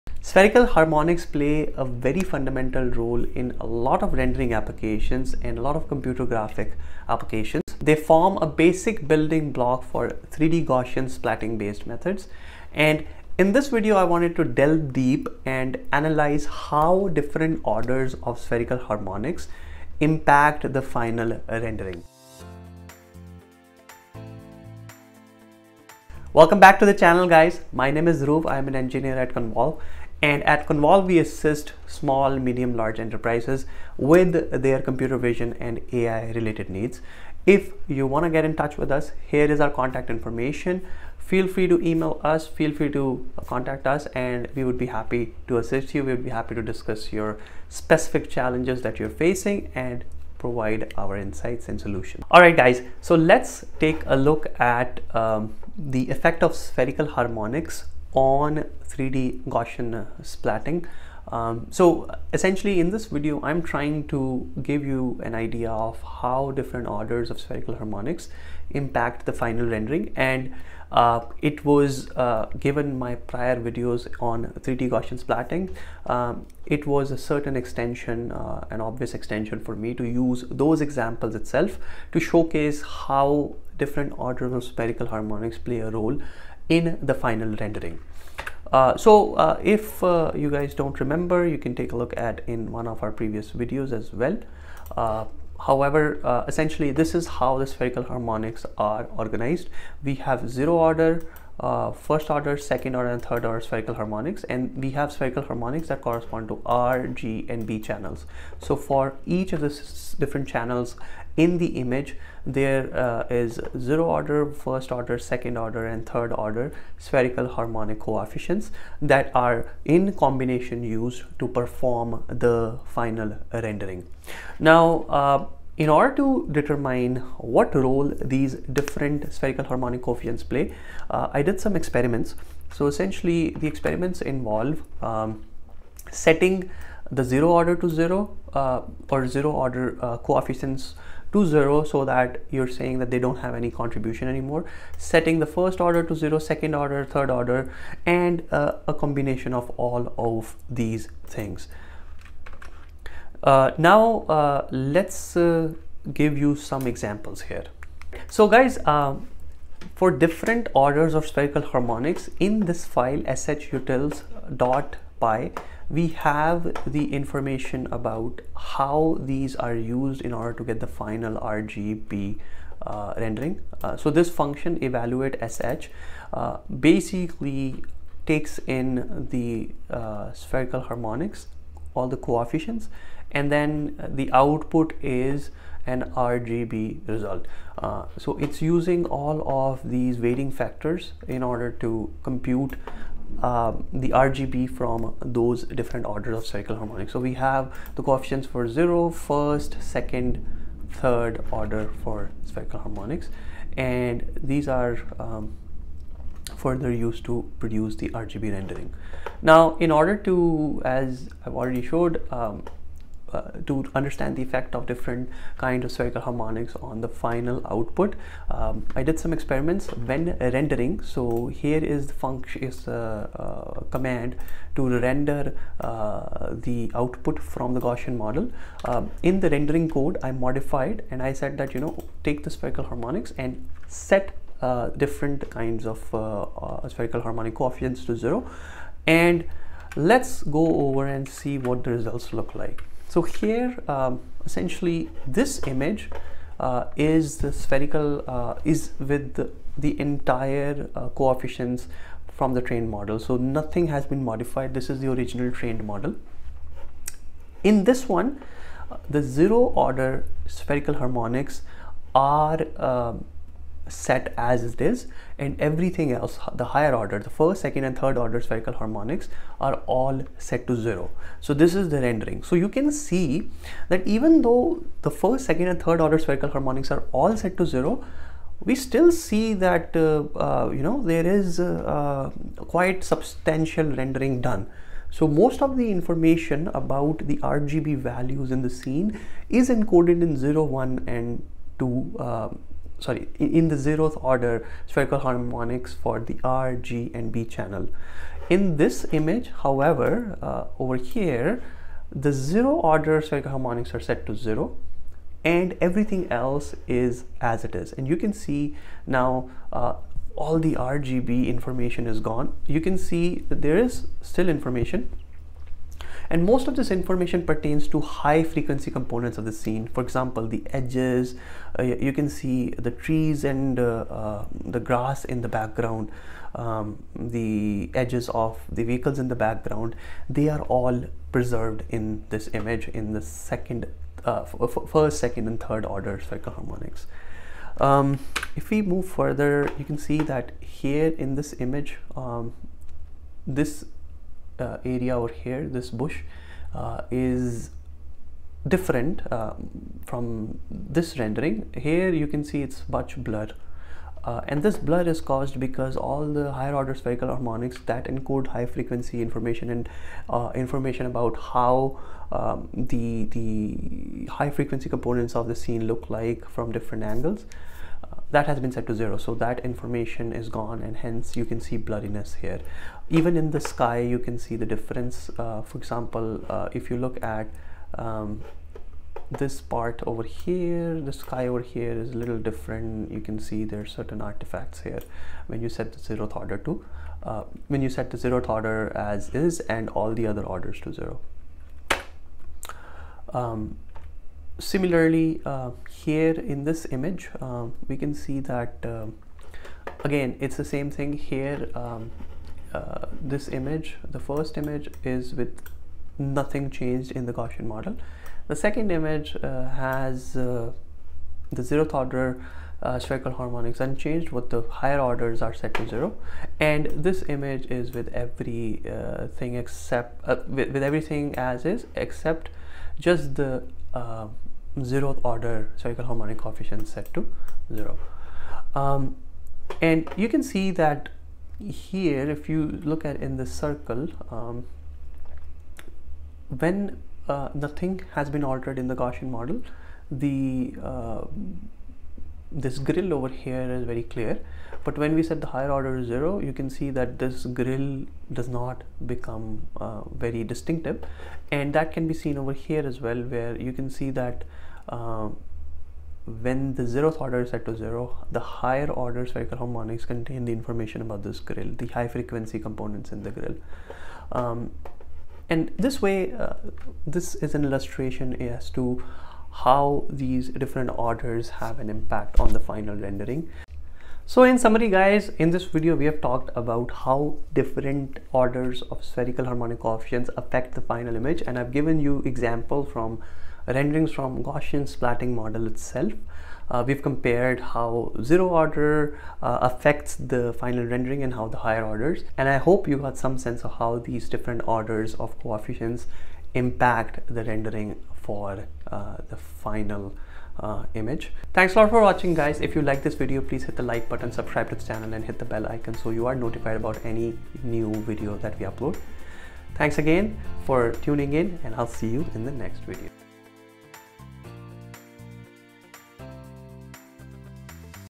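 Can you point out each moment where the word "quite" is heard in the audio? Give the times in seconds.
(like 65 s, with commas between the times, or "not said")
282 s.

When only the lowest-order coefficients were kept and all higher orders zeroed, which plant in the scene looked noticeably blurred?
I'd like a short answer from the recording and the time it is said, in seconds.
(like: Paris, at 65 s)
bush, at 345 s.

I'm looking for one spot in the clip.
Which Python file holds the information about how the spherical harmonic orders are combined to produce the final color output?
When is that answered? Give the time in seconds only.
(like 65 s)
163 s.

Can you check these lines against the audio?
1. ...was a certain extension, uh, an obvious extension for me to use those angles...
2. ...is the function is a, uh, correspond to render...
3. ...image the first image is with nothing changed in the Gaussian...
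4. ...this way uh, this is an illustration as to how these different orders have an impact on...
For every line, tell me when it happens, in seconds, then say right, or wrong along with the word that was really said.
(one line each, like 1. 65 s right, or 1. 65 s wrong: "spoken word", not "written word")
1. 76 s wrong: "examples", not "angles"
2. 221 s wrong: "command", not "correspond"
3. 403 s right
4. 465 s right.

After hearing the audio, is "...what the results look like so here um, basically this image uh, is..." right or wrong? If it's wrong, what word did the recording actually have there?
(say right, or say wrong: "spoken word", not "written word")
wrong: "essentially", not "basically".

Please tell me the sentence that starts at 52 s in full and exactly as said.
All right, guys, so let's take a look at um, the effect of spherical harmonics on 3D Gaussian uh, splatting.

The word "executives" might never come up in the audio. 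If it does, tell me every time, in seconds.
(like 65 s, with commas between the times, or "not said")
not said.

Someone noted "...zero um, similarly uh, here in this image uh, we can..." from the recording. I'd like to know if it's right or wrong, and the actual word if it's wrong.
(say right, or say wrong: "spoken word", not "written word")
right.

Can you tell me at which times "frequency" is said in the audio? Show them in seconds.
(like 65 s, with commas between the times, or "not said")
318 s, 358 s, 364 s, 462 s.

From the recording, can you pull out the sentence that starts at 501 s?
Thanks a lot for watching guys.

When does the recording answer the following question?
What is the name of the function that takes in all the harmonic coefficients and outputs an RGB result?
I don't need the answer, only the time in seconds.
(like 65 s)
174 s.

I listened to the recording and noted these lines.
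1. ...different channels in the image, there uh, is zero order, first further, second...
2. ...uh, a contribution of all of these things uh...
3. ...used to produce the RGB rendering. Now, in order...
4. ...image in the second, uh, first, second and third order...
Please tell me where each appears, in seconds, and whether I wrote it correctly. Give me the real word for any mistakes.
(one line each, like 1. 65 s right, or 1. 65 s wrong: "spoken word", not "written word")
1. 110 s wrong: "order", not "further"
2. 148 s wrong: "combination", not "contribution"
3. 207 s right
4. 332 s right.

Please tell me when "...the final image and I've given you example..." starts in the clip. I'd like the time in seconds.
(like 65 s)
480 s.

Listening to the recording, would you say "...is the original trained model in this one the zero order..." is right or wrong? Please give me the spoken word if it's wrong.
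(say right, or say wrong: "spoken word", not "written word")
right.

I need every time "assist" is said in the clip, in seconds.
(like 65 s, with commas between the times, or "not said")
31 s, 45 s.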